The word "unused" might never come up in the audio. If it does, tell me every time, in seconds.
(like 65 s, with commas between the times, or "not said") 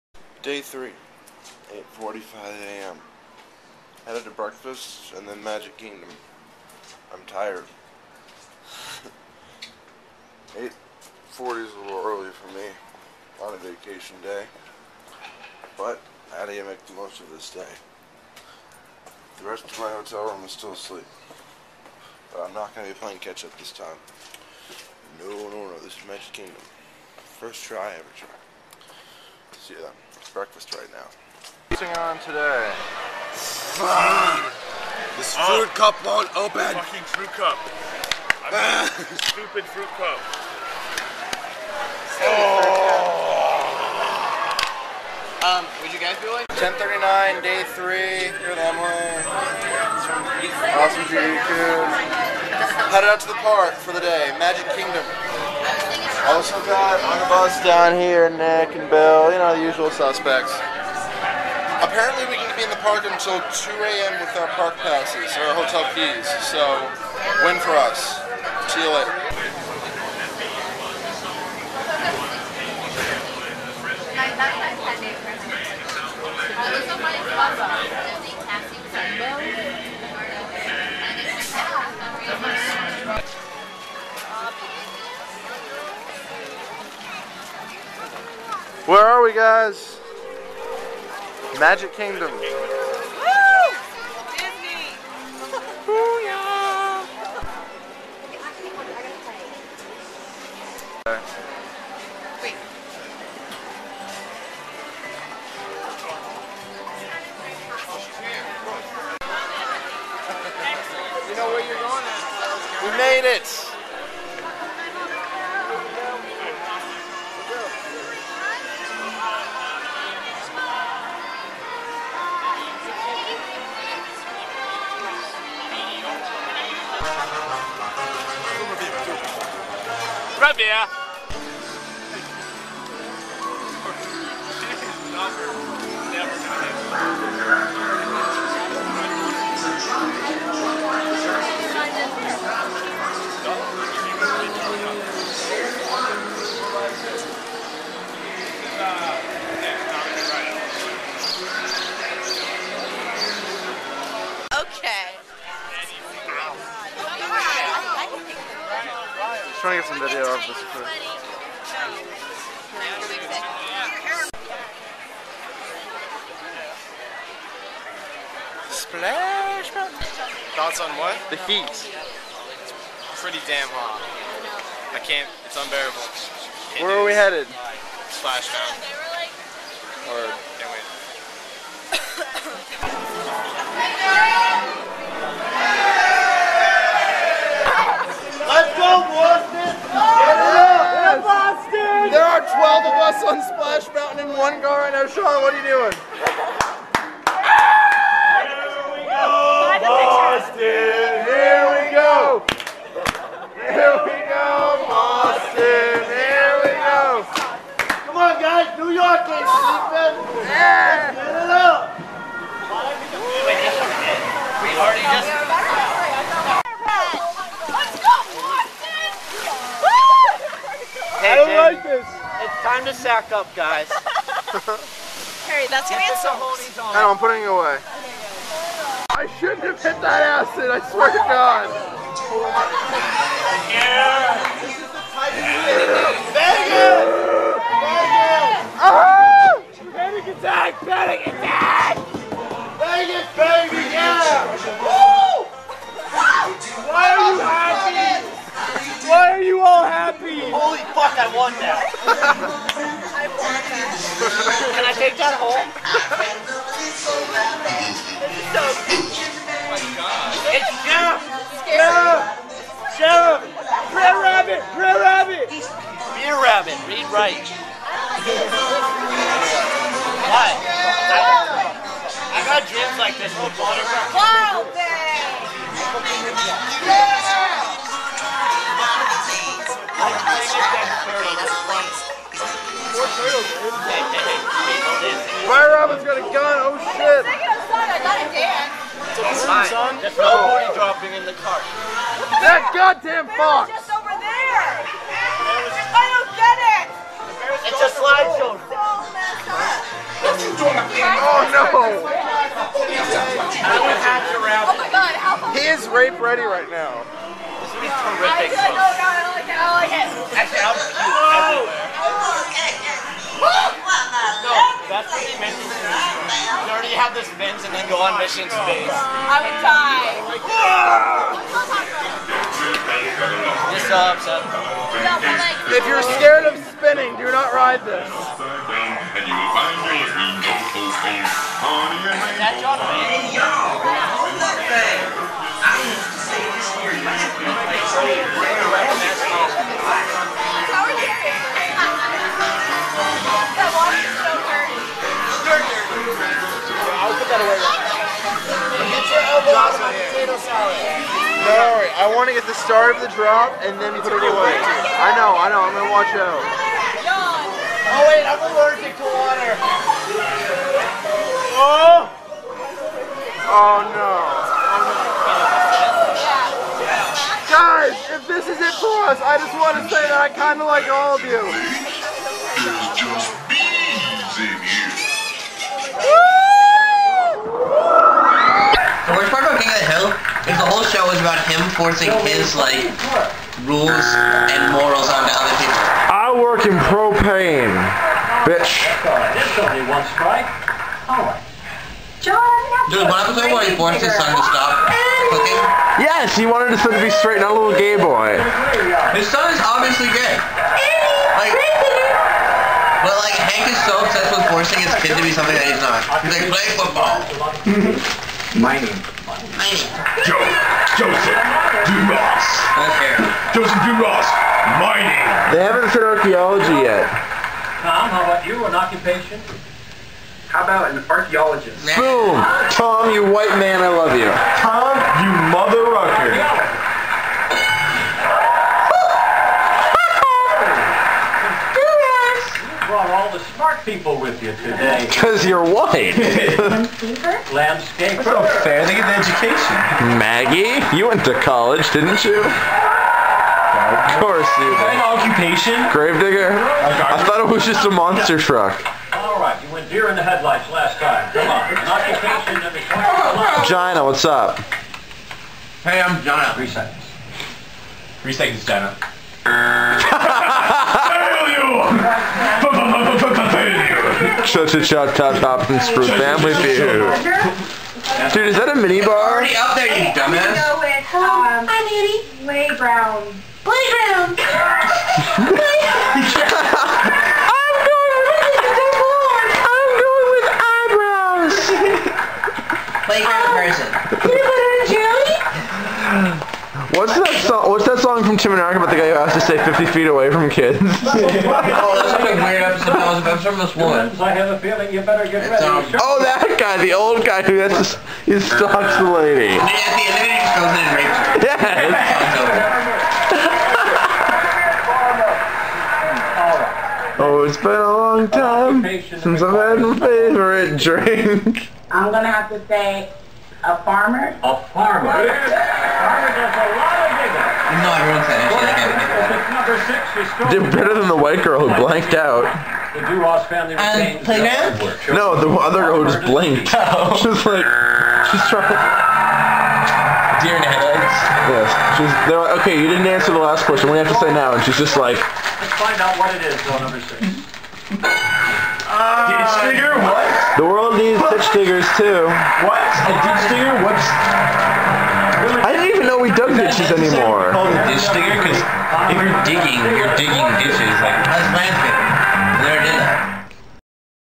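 not said.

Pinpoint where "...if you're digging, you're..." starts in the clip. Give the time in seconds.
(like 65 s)
549 s.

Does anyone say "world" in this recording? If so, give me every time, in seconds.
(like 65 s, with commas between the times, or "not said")
540 s.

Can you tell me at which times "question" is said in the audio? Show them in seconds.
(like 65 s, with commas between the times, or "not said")
533 s.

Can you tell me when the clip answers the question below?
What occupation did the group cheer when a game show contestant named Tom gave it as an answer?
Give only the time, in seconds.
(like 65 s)
421 s.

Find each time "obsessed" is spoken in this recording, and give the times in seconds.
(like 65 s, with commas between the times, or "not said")
403 s.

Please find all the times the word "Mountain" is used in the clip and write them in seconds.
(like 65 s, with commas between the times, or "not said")
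169 s, 178 s, 193 s.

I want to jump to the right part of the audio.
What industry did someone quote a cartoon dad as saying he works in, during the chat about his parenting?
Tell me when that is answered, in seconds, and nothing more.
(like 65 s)
386 s.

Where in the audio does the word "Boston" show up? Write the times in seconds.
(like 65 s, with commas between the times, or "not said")
200 s, 204 s.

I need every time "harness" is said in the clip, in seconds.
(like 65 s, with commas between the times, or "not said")
not said.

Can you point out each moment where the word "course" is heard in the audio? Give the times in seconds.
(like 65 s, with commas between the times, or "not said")
444 s.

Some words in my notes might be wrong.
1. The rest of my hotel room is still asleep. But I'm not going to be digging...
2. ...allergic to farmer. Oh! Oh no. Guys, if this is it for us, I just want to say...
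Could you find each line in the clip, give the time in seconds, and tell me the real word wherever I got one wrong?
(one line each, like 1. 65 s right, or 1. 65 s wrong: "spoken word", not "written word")
1. 19 s wrong: "playing", not "digging"
2. 358 s wrong: "water", not "farmer".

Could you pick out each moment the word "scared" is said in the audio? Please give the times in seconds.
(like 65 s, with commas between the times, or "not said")
326 s.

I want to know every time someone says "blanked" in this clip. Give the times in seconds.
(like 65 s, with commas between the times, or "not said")
521 s, 526 s.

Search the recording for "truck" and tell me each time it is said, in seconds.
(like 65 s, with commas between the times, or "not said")
448 s.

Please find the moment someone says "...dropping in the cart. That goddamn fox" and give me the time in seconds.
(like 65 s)
290 s.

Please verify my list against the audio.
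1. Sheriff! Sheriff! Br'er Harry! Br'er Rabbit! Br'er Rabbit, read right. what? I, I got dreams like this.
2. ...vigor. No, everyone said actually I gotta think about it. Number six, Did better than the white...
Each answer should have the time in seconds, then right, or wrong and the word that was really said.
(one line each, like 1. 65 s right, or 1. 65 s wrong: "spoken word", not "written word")
1. 261 s wrong: "Rabbit", not "Harry"
2. 517 s right.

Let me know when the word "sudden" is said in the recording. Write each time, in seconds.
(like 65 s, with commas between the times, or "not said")
not said.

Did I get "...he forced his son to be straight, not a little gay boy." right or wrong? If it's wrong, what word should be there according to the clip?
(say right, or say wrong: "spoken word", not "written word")
wrong: "wanted", not "forced".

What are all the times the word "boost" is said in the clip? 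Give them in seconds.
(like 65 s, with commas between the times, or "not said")
not said.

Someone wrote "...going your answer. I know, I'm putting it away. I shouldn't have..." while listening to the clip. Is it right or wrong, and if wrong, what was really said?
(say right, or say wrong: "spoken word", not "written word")
right.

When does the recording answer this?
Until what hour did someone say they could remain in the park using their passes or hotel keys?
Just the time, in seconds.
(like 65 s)
63 s.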